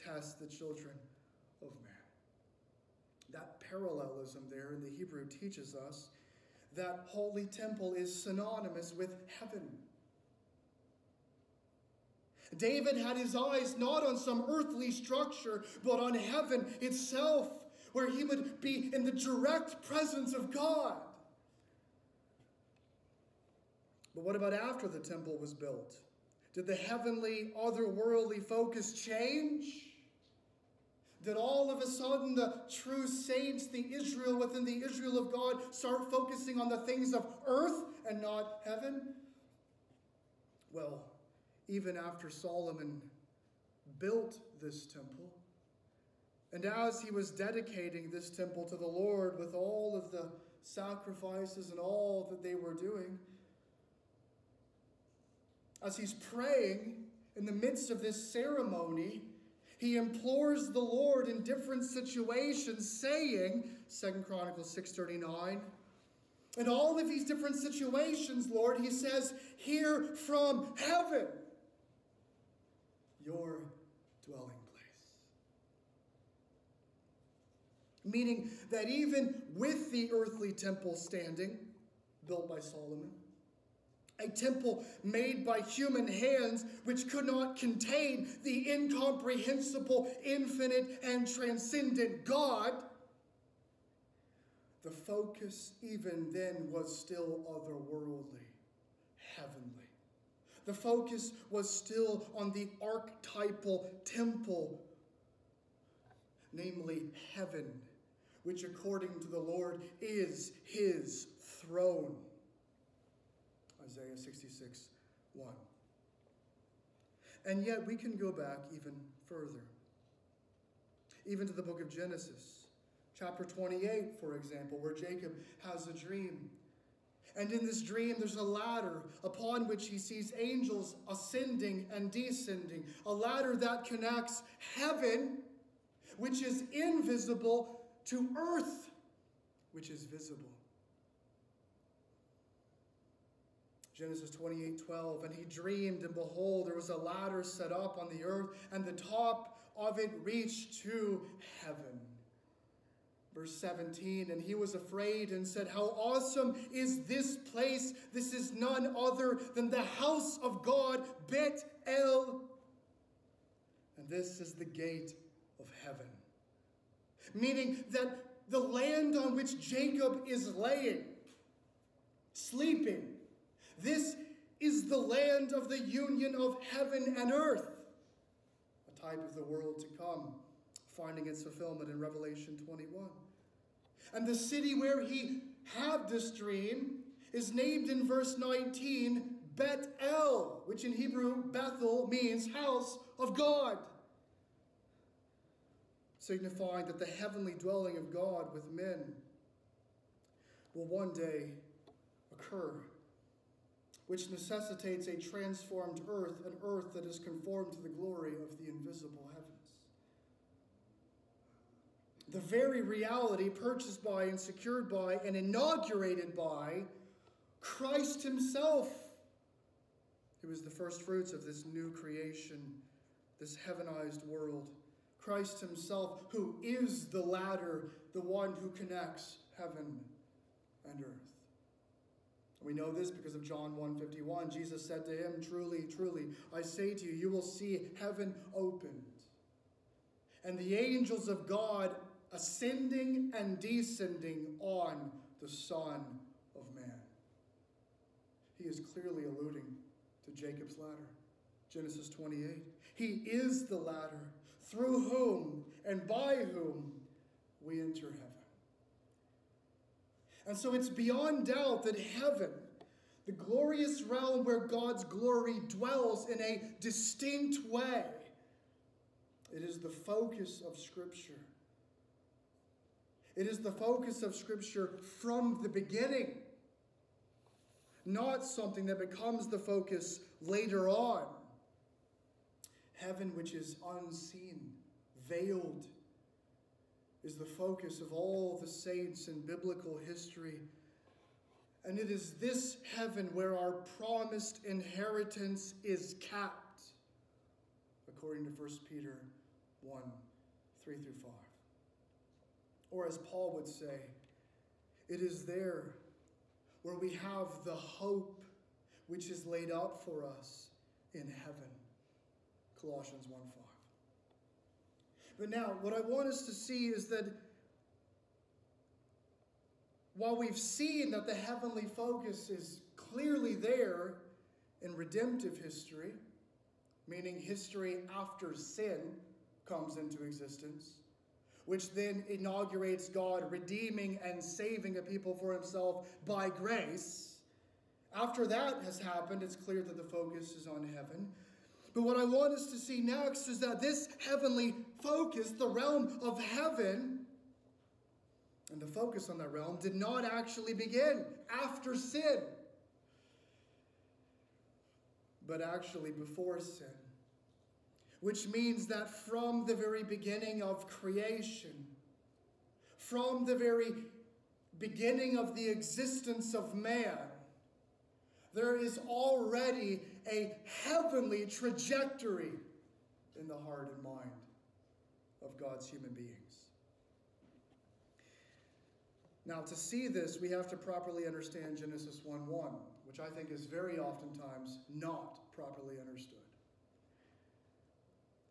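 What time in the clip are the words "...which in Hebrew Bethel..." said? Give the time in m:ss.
3:10.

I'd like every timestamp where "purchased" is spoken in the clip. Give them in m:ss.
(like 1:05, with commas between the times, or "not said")
3:33.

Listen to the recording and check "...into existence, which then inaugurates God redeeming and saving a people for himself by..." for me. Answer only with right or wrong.
right.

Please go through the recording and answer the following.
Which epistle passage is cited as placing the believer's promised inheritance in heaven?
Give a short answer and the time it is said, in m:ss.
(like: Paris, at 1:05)
1 Peter 1:3-5, at 4:58.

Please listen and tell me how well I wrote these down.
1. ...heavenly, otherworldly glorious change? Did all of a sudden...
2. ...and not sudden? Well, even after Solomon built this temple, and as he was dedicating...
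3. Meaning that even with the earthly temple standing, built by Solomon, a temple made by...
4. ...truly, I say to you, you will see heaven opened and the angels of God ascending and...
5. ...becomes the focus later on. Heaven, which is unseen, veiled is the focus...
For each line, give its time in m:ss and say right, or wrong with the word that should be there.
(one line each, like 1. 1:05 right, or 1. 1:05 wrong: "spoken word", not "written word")
1. 0:26 wrong: "focus", not "glorious"
2. 0:38 wrong: "heaven", not "sudden"
3. 1:18 right
4. 3:55 right
5. 4:38 right.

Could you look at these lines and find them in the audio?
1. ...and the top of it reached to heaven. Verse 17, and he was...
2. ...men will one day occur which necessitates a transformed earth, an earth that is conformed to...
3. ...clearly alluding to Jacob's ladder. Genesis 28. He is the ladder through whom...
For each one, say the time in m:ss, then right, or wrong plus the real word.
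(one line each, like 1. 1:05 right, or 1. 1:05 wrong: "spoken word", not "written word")
1. 2:28 right
2. 3:18 right
3. 4:08 right.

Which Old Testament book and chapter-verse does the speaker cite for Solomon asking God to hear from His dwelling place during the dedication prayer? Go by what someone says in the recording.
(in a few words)
2 Chronicles 6:39.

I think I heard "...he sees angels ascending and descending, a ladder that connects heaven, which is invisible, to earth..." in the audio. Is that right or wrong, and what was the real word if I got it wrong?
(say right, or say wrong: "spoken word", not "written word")
right.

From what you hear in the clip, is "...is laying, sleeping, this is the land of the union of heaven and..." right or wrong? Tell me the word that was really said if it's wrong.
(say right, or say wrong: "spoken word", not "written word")
right.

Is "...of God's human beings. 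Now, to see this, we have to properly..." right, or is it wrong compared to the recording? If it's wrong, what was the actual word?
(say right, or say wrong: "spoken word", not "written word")
right.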